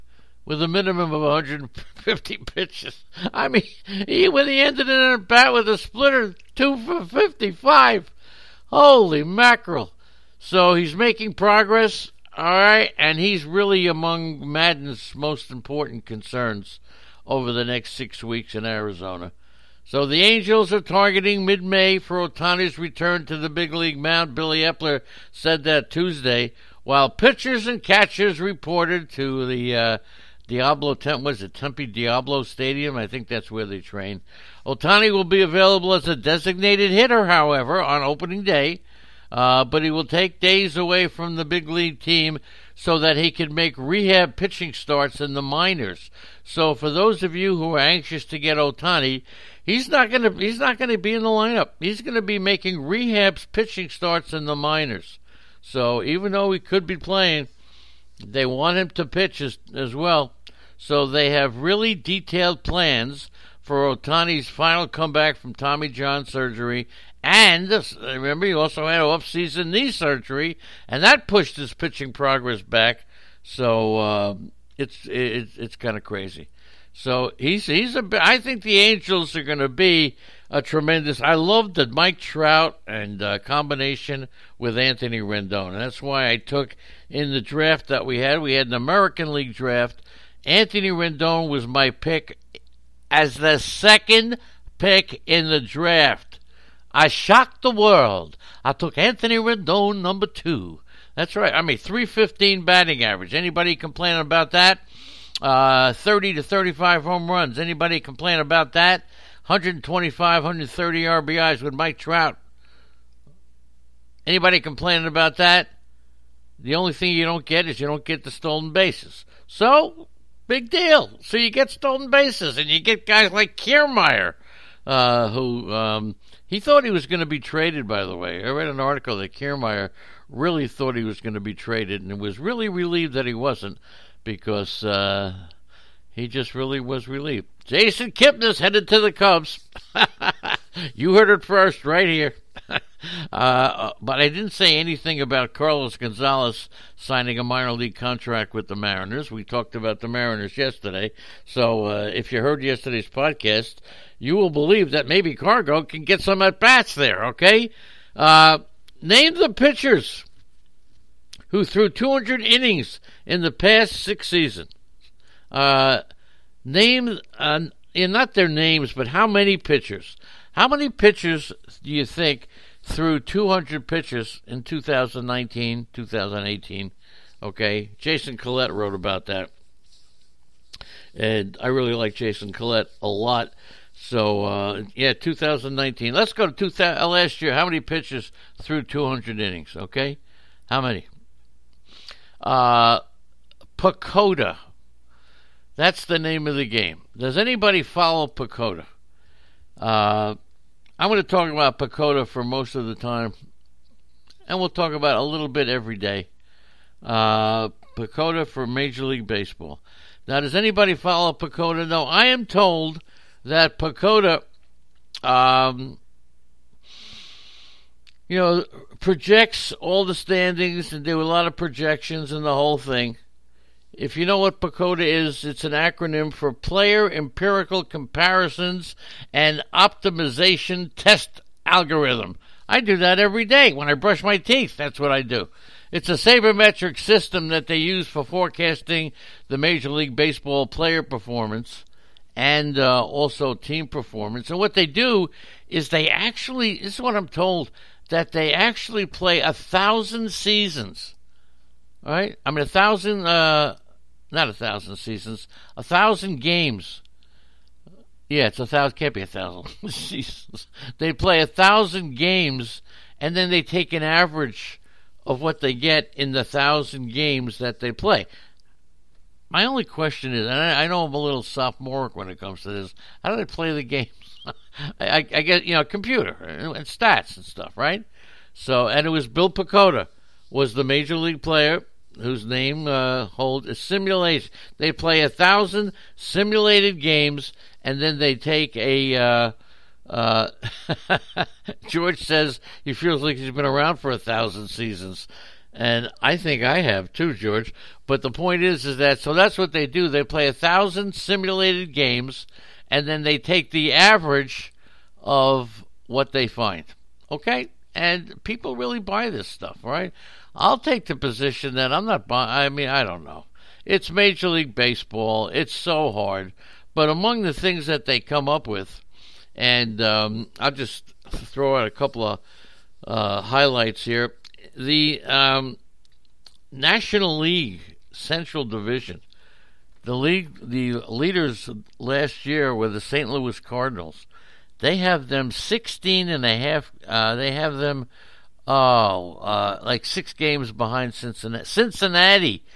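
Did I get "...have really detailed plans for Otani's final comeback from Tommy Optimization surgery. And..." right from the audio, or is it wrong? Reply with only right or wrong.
wrong.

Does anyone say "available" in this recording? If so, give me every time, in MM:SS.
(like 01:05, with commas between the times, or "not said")
00:35.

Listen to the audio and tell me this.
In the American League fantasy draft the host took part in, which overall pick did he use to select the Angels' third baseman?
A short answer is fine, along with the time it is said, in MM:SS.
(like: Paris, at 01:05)
2, at 01:33.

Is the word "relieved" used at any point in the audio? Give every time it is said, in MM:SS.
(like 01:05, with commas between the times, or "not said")
02:12, 02:17.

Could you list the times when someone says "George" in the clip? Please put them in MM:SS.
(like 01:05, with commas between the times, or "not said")
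04:51, 04:57.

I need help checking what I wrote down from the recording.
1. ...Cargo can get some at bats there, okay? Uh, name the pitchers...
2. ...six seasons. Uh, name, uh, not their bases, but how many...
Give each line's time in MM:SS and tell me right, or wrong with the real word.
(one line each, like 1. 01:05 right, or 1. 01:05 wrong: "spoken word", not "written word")
1. 02:35 right
2. 02:43 wrong: "names", not "bases".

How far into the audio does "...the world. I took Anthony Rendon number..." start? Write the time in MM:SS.
01:37.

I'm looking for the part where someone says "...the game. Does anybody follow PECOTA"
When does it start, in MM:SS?
03:16.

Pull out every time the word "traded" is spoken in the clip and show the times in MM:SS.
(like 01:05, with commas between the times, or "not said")
02:07, 02:11.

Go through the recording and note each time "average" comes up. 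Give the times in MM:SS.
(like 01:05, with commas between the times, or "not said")
01:43, 04:24, 05:03.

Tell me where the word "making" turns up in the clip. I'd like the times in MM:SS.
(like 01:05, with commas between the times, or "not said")
00:10, 00:52.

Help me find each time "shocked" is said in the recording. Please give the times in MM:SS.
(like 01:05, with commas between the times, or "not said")
01:37.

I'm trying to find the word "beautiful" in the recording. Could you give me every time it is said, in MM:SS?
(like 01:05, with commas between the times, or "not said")
not said.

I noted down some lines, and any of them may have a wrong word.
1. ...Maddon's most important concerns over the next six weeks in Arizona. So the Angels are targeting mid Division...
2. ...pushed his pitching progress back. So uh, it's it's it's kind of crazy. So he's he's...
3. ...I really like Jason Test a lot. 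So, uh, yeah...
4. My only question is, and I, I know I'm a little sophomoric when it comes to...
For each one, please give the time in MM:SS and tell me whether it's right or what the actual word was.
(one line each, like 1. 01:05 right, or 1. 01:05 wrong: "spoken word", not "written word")
1. 00:14 wrong: "May", not "Division"
2. 01:11 right
3. 03:01 wrong: "Collette", not "Test"
4. 04:29 right.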